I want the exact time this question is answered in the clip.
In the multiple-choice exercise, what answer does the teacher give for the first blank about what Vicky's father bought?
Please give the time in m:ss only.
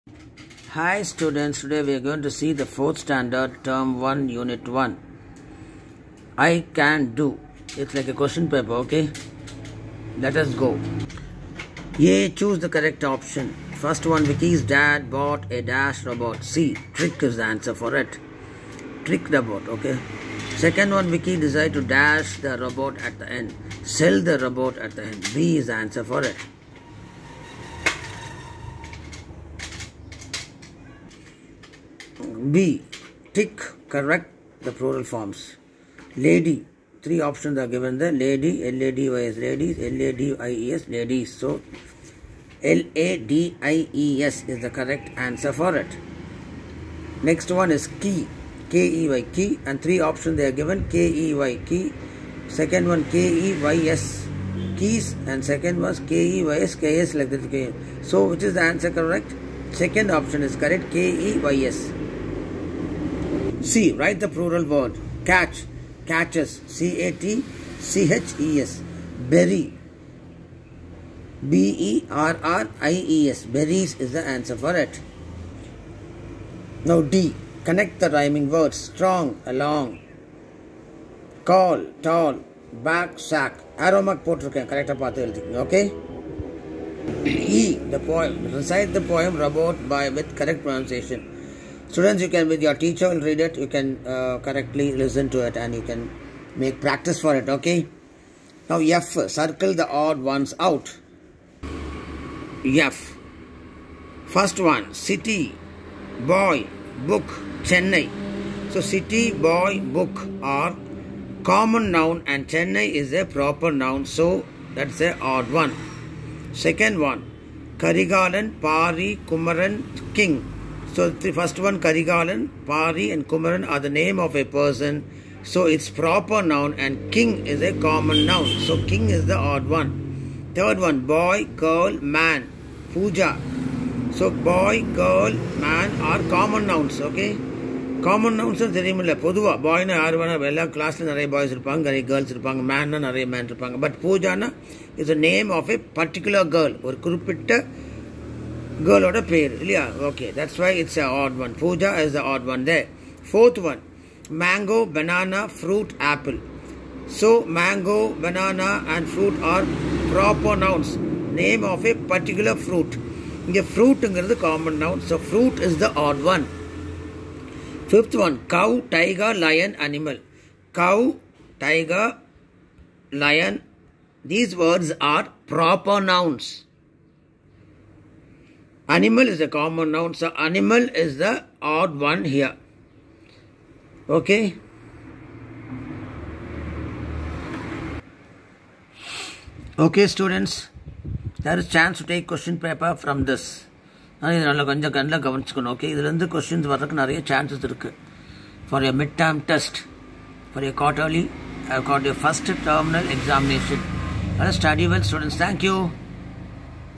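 0:19.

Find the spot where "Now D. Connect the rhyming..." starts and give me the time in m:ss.
1:16.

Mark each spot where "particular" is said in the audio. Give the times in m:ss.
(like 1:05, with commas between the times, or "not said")
2:25, 2:41.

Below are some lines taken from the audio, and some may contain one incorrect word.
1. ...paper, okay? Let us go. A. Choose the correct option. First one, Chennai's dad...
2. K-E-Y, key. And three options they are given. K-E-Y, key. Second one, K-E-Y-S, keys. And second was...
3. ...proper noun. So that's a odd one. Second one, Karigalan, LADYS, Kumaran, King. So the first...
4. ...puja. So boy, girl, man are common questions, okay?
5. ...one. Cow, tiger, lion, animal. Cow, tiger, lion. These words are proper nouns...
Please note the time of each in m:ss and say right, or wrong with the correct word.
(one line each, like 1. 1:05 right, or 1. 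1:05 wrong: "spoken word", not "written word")
1. 0:08 wrong: "Vicky", not "Chennai"
2. 0:48 right
3. 1:53 wrong: "Pari", not "LADYS"
4. 2:12 wrong: "nouns", not "questions"
5. 2:48 right.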